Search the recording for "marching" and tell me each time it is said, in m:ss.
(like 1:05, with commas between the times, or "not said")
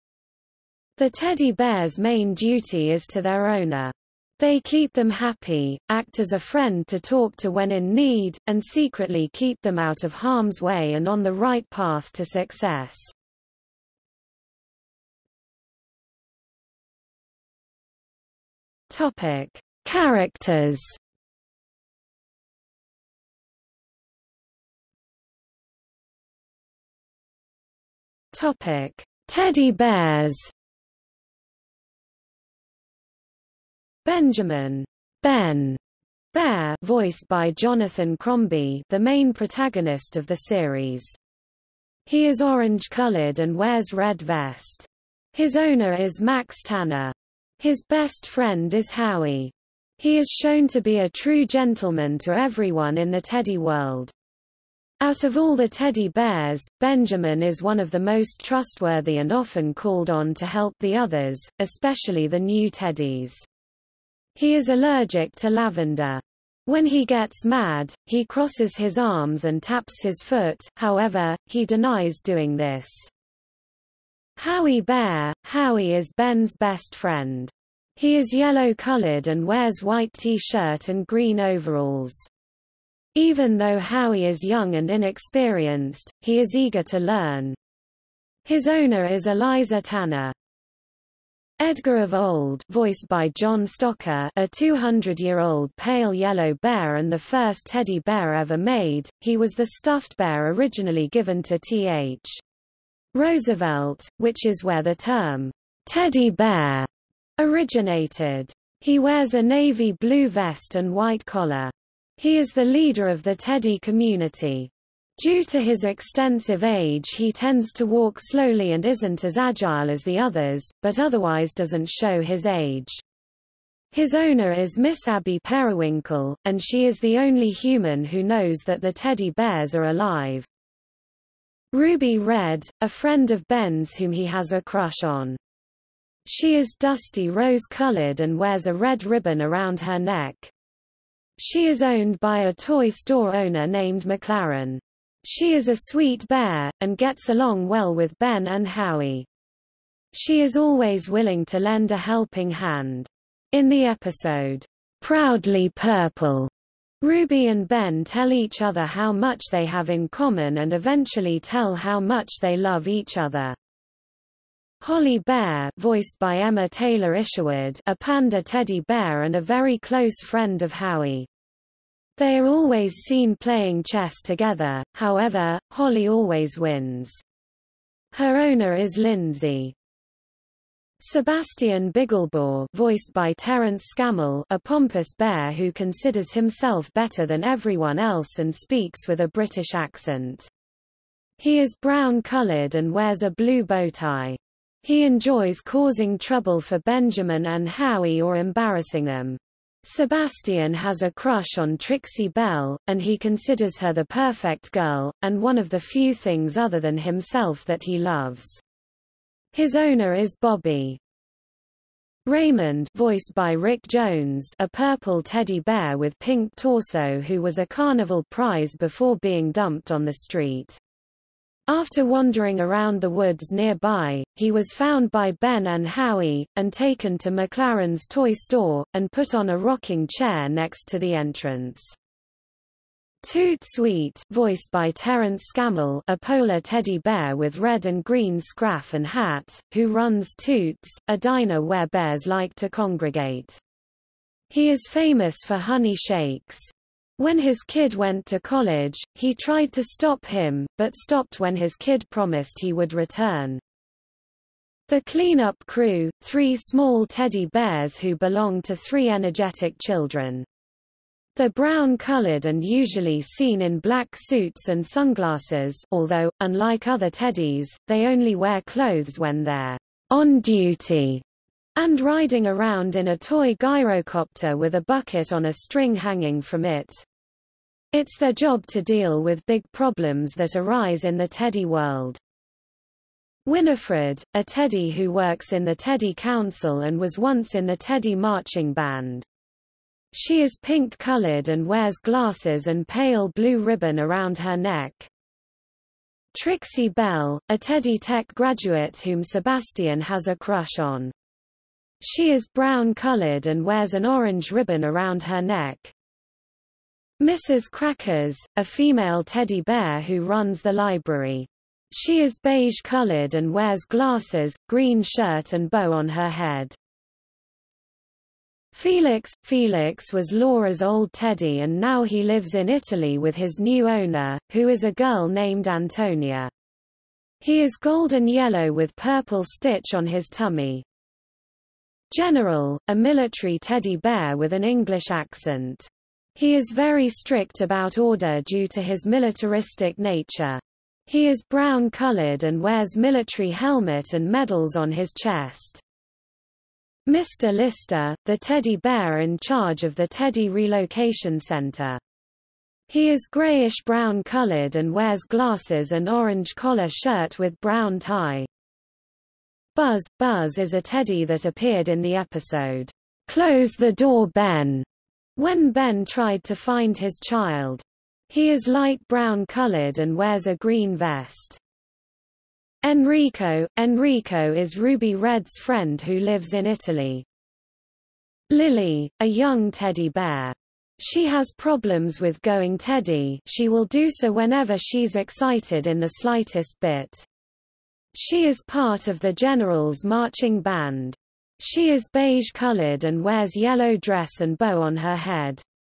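4:48, 6:30.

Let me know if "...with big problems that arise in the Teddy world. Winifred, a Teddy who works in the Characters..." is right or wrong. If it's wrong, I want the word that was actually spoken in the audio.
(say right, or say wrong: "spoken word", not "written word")
wrong: "Teddy", not "Characters".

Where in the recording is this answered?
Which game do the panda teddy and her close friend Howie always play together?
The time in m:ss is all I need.
2:53.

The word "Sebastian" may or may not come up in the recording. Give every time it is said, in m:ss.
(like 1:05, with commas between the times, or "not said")
3:01, 3:19, 4:59.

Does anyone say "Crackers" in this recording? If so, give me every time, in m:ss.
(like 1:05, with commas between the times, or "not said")
5:07.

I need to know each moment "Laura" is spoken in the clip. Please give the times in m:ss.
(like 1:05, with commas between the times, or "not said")
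5:20.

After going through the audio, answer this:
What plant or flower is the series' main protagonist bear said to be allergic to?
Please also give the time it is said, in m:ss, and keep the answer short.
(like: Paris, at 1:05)
Lavender, at 1:05.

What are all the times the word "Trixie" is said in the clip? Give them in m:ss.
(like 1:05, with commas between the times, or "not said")
3:21, 4:56.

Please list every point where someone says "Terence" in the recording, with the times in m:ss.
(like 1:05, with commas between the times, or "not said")
3:03, 3:54.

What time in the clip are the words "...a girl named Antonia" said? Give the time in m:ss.
5:24.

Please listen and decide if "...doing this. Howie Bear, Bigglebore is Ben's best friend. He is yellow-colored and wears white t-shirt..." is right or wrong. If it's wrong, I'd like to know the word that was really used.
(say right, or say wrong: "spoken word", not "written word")
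wrong: "Howie", not "Bigglebore".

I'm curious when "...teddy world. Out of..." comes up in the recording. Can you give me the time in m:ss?
0:53.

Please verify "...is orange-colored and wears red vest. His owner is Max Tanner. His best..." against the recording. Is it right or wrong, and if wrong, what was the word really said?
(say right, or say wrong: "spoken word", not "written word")
right.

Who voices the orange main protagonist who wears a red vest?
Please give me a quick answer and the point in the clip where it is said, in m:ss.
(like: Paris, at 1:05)
Jonathan Crombie, at 0:37.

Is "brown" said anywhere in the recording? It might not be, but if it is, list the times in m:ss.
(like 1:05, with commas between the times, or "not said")
3:11, 4:21, 5:02, 5:41, 5:53, 5:57, 6:09.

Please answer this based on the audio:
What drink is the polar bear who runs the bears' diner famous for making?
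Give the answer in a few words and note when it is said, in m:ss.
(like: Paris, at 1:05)
Honey shakes, at 4:05.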